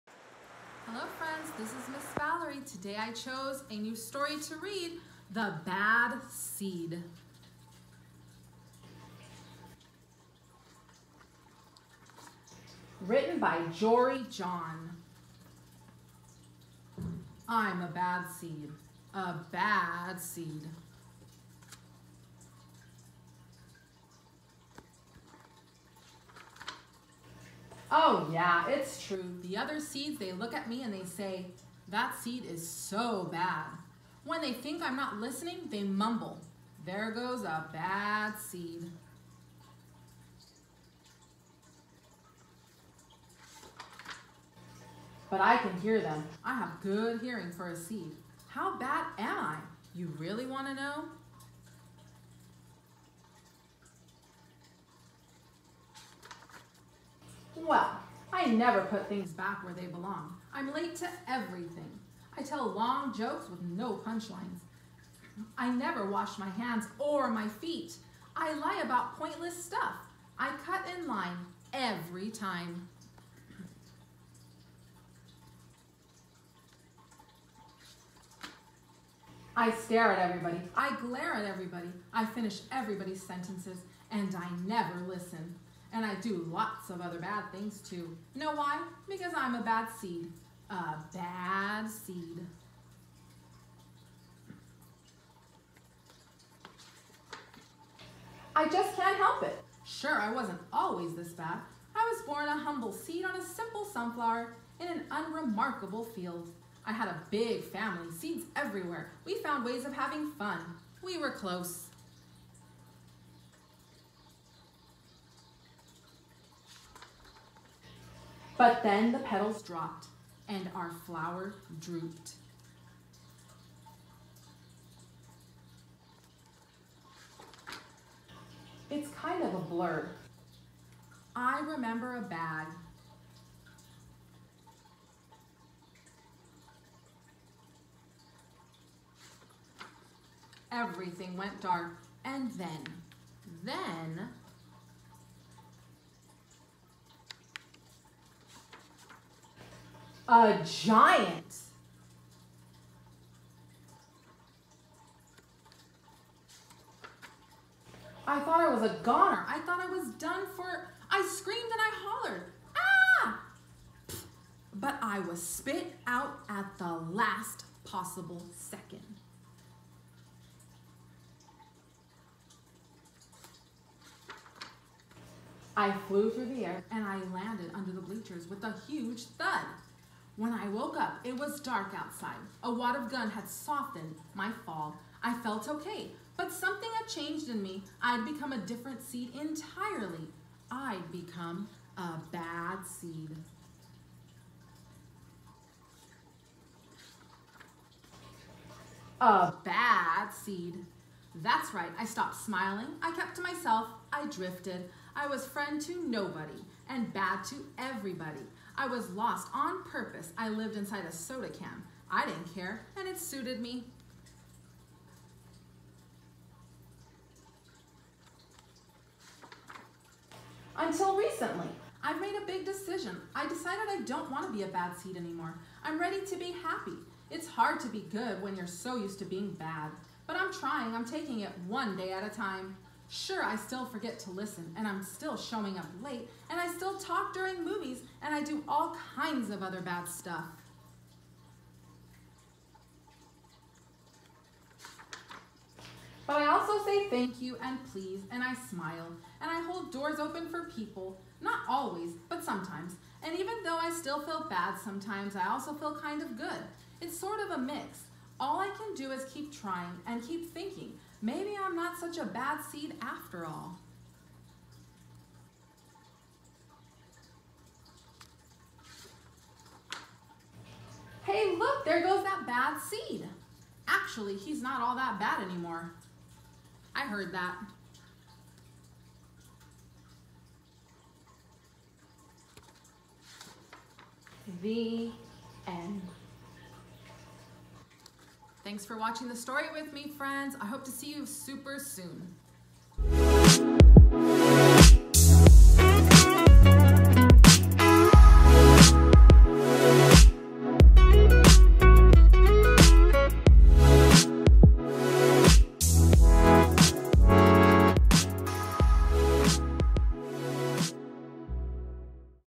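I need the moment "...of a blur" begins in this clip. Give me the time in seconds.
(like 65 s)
129 s.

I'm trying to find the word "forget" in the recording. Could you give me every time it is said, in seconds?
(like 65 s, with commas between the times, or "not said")
233 s.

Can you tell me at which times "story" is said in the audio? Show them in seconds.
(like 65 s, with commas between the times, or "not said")
3 s, 289 s.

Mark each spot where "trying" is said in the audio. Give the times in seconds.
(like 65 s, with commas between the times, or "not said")
230 s, 259 s.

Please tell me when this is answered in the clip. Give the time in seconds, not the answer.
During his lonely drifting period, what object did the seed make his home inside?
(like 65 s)
211 s.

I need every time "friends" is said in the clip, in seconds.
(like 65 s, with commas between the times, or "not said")
1 s, 205 s, 290 s.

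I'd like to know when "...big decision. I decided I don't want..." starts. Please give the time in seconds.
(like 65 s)
222 s.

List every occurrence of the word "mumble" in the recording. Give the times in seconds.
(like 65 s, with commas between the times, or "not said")
35 s.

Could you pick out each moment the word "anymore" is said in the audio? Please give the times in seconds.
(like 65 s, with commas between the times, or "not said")
225 s, 275 s.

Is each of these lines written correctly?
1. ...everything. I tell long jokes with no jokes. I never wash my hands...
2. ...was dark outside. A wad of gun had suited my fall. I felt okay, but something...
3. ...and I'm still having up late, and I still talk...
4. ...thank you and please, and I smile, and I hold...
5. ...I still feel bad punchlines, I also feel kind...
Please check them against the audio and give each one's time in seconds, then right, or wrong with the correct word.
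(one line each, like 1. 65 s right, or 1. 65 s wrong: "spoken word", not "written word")
1. 61 s wrong: "punchlines", not "jokes"
2. 181 s wrong: "softened", not "suited"
3. 234 s wrong: "showing", not "having"
4. 247 s right
5. 253 s wrong: "sometimes", not "punchlines".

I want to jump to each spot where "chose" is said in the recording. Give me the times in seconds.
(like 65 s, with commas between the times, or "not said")
3 s.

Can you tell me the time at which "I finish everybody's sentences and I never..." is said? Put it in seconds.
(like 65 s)
82 s.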